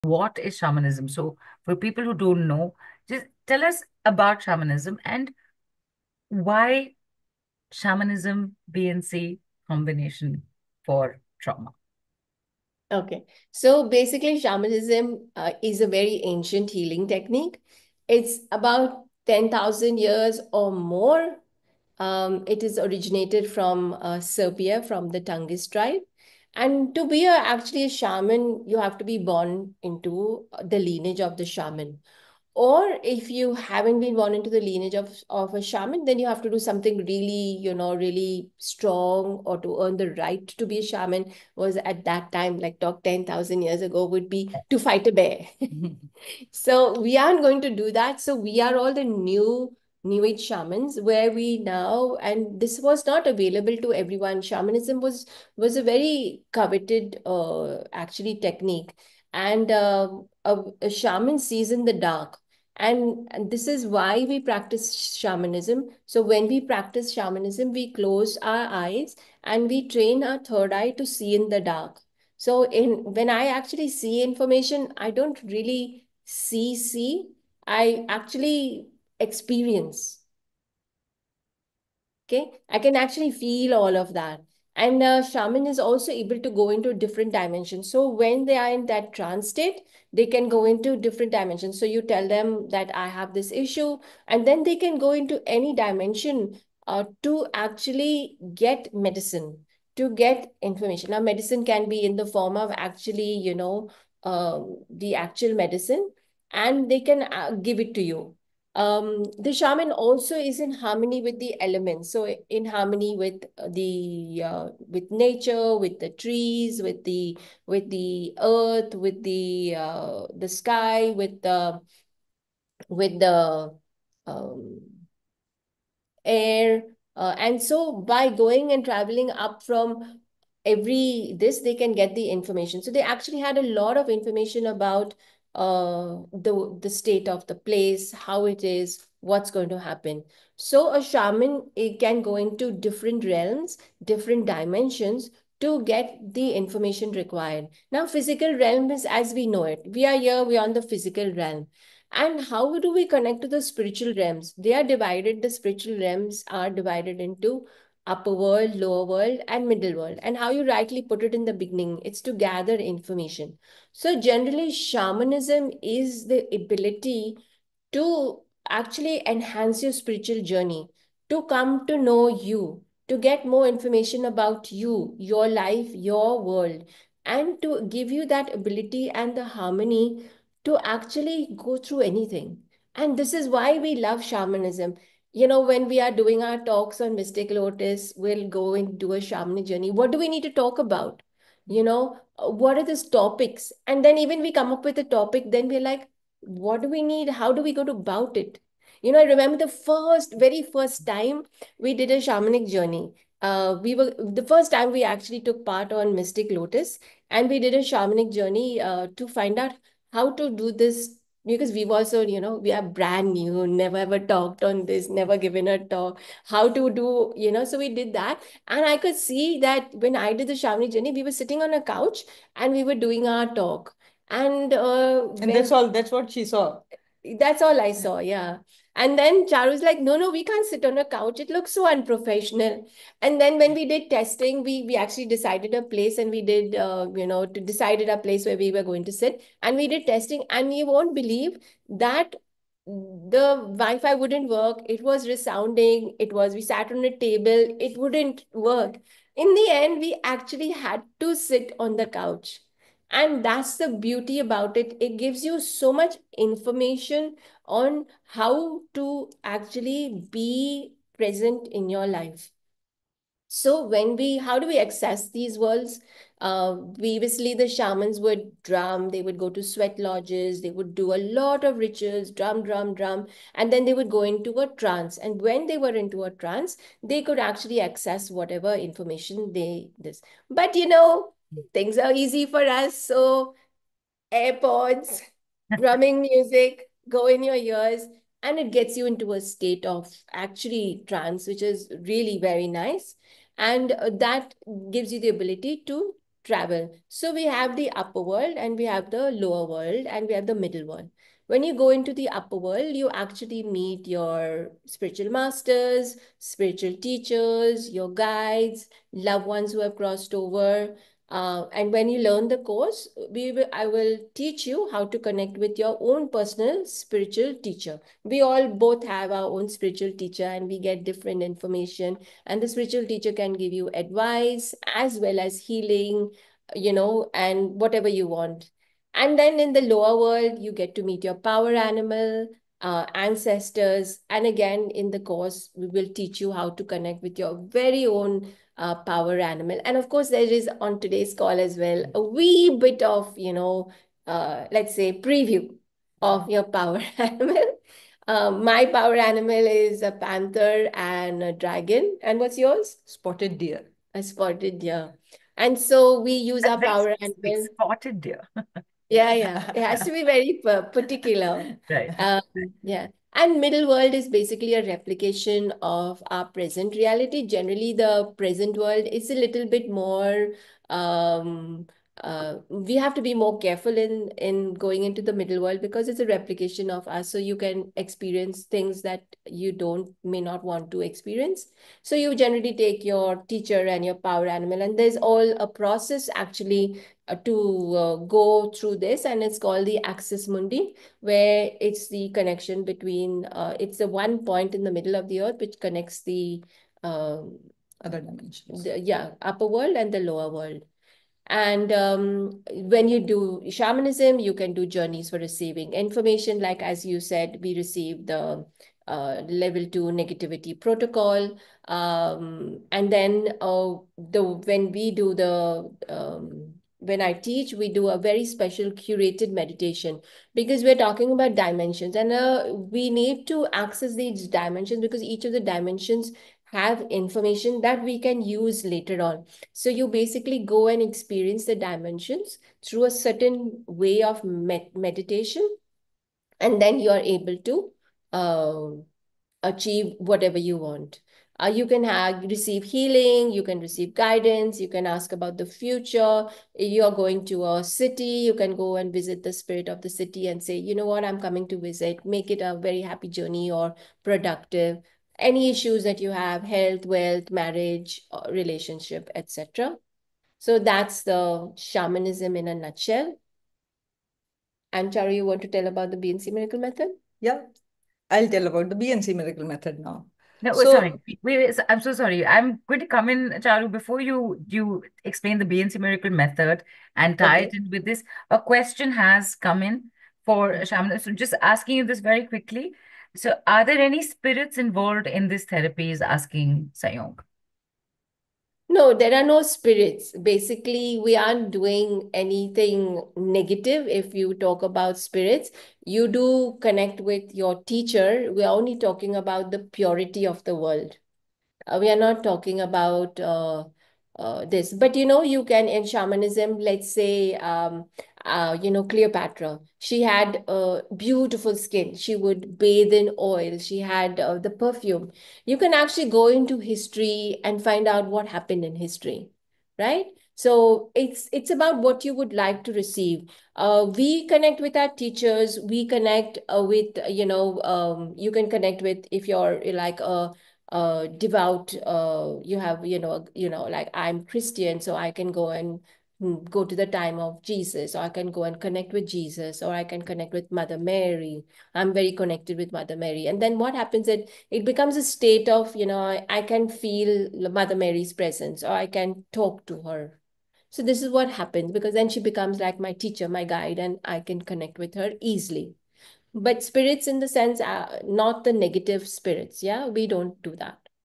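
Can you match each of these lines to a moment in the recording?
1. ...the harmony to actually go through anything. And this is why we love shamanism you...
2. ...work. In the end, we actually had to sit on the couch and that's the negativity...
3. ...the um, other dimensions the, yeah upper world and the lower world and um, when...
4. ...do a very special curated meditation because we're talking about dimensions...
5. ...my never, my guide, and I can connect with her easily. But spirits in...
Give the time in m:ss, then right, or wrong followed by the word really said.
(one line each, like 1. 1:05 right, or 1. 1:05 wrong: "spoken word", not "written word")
1. 2:59 right
2. 4:08 wrong: "beauty", not "negativity"
3. 6:36 right
4. 6:57 right
5. 9:12 wrong: "teacher", not "never".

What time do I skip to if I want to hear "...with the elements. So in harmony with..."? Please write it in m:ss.
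1:51.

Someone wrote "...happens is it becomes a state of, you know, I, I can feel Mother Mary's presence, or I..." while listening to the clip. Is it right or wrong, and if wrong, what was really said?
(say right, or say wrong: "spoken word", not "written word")
right.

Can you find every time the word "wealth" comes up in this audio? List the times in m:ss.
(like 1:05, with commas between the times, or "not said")
7:37.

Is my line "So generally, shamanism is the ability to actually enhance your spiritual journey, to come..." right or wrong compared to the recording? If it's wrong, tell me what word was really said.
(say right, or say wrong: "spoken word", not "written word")
right.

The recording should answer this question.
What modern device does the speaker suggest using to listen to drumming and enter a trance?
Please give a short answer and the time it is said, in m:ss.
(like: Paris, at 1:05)
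AirPods, at 4:44.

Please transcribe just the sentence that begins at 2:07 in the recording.
Uh, and so by going and traveling up from every this, they can get the information.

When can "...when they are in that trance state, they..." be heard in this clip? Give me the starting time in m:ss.
1:28.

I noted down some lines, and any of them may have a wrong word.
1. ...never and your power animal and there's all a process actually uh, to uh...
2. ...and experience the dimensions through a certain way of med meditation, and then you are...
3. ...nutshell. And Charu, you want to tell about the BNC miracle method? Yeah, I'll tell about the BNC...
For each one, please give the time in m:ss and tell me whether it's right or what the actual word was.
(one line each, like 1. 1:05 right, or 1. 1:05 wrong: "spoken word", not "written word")
1. 6:23 wrong: "teacher", not "never"
2. 7:10 right
3. 7:42 right.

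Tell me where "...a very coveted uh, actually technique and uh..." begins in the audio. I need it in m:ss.
0:55.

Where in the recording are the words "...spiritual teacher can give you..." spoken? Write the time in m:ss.
5:22.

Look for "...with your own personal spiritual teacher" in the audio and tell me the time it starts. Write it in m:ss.
5:15.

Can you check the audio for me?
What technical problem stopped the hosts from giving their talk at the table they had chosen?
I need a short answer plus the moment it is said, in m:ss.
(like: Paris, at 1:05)
Wi-Fi, at 4:03.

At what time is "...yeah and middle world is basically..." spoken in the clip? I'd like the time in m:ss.
6:02.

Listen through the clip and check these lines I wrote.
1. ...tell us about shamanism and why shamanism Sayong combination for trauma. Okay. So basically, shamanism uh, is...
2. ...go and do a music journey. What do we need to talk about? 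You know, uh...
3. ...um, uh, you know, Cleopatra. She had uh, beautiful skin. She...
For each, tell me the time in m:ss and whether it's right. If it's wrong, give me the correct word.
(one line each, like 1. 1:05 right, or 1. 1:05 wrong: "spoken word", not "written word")
1. 0:03 wrong: "BNC", not "Sayong"
2. 3:08 wrong: "shamanic", not "music"
3. 8:27 right.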